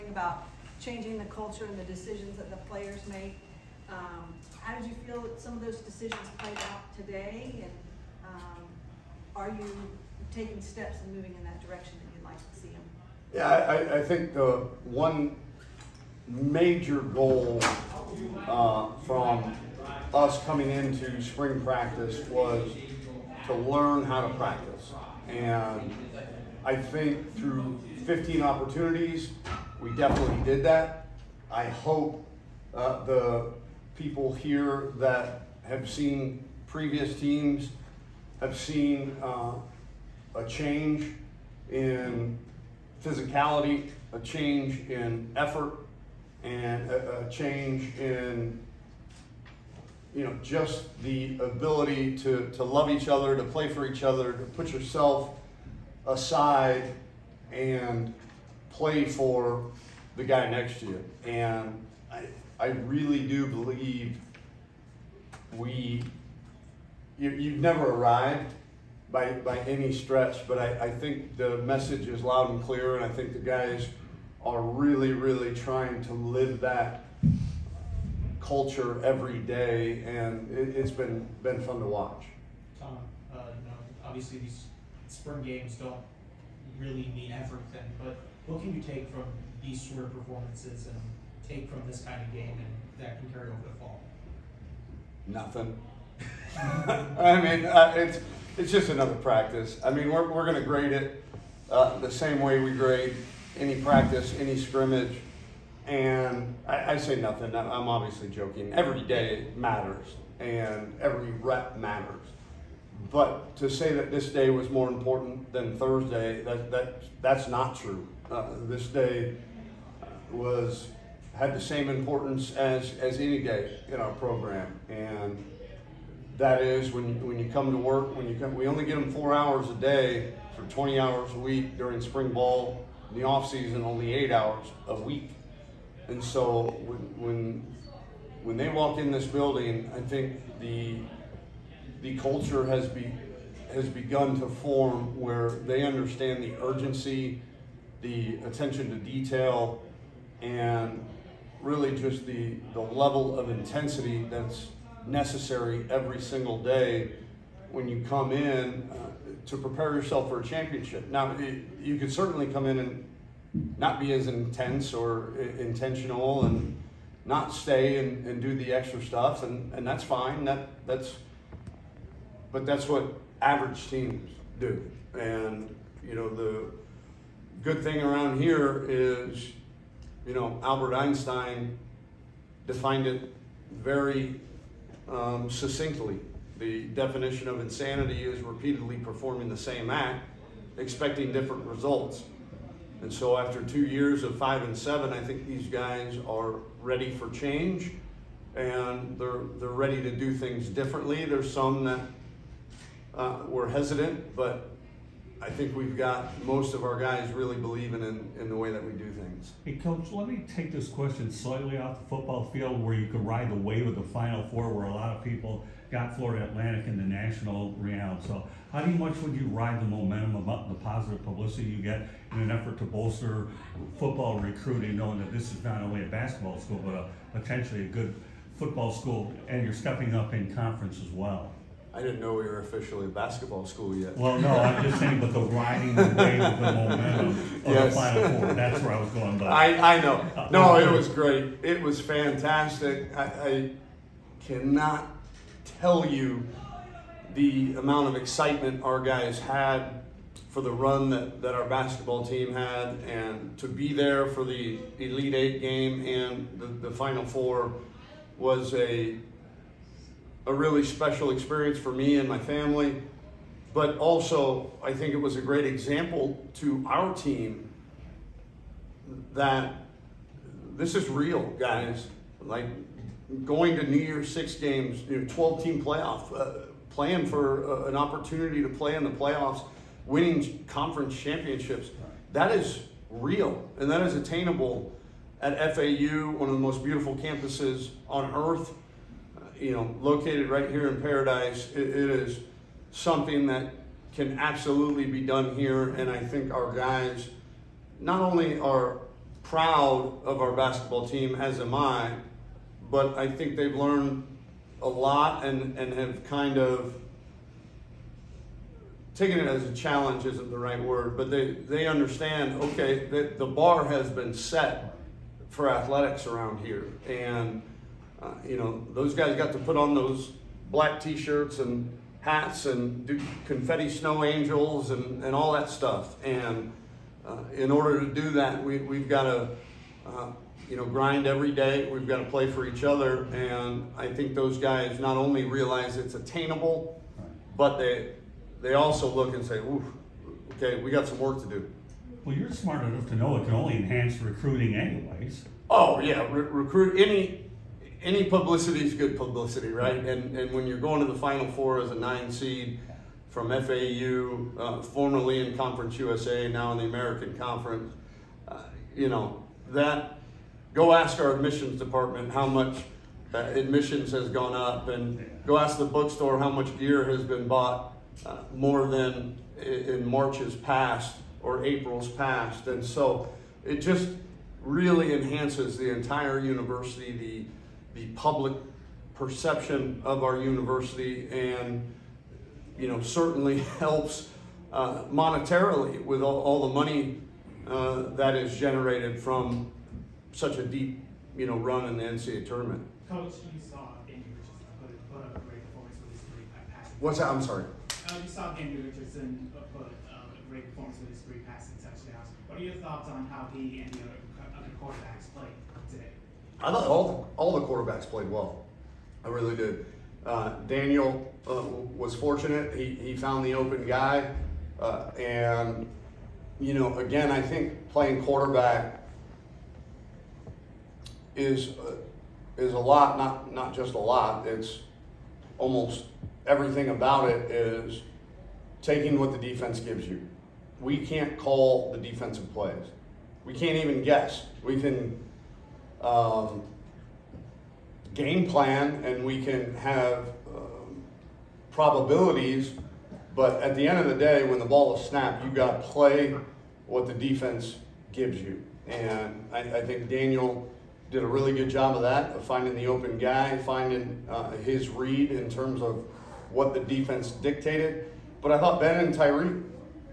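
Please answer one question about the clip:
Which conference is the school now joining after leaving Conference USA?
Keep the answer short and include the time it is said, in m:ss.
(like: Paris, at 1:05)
American Conference, at 5:56.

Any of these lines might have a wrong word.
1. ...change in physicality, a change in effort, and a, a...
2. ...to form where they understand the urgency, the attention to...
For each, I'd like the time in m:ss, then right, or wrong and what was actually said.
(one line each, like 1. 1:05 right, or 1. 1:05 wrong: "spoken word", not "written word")
1. 0:40 right
2. 2:24 right.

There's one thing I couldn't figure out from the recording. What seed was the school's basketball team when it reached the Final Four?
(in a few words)
9.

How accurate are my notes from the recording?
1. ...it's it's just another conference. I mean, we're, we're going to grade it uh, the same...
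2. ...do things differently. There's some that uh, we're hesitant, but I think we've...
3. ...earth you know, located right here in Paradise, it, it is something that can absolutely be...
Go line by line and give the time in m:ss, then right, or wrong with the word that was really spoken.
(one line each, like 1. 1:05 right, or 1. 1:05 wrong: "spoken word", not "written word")
1. 1:37 wrong: "practice", not "conference"
2. 3:20 right
3. 4:48 right.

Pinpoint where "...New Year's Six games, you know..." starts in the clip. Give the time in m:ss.
4:33.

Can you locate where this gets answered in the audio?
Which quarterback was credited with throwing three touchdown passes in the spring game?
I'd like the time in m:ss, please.
6:38.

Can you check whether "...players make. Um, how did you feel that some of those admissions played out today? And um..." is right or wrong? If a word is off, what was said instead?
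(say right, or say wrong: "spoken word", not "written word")
wrong: "decisions", not "admissions".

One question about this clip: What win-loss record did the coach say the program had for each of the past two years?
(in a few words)
5 and 7.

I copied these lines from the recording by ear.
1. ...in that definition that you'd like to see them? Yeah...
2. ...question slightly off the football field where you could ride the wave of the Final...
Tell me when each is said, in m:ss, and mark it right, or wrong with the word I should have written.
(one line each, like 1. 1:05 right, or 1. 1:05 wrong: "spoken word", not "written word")
1. 0:11 wrong: "direction", not "definition"
2. 3:30 right.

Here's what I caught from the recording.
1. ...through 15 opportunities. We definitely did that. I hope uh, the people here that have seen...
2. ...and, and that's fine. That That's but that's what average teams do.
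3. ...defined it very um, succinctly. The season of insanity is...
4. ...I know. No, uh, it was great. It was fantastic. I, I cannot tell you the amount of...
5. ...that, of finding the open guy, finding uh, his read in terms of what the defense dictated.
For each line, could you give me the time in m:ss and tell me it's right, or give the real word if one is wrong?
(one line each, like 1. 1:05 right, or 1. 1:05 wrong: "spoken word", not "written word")
1. 0:27 right
2. 2:49 right
3. 3:02 wrong: "definition", not "season"
4. 3:59 right
5. 7:32 right.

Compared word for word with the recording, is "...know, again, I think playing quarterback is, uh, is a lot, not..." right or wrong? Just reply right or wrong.
right.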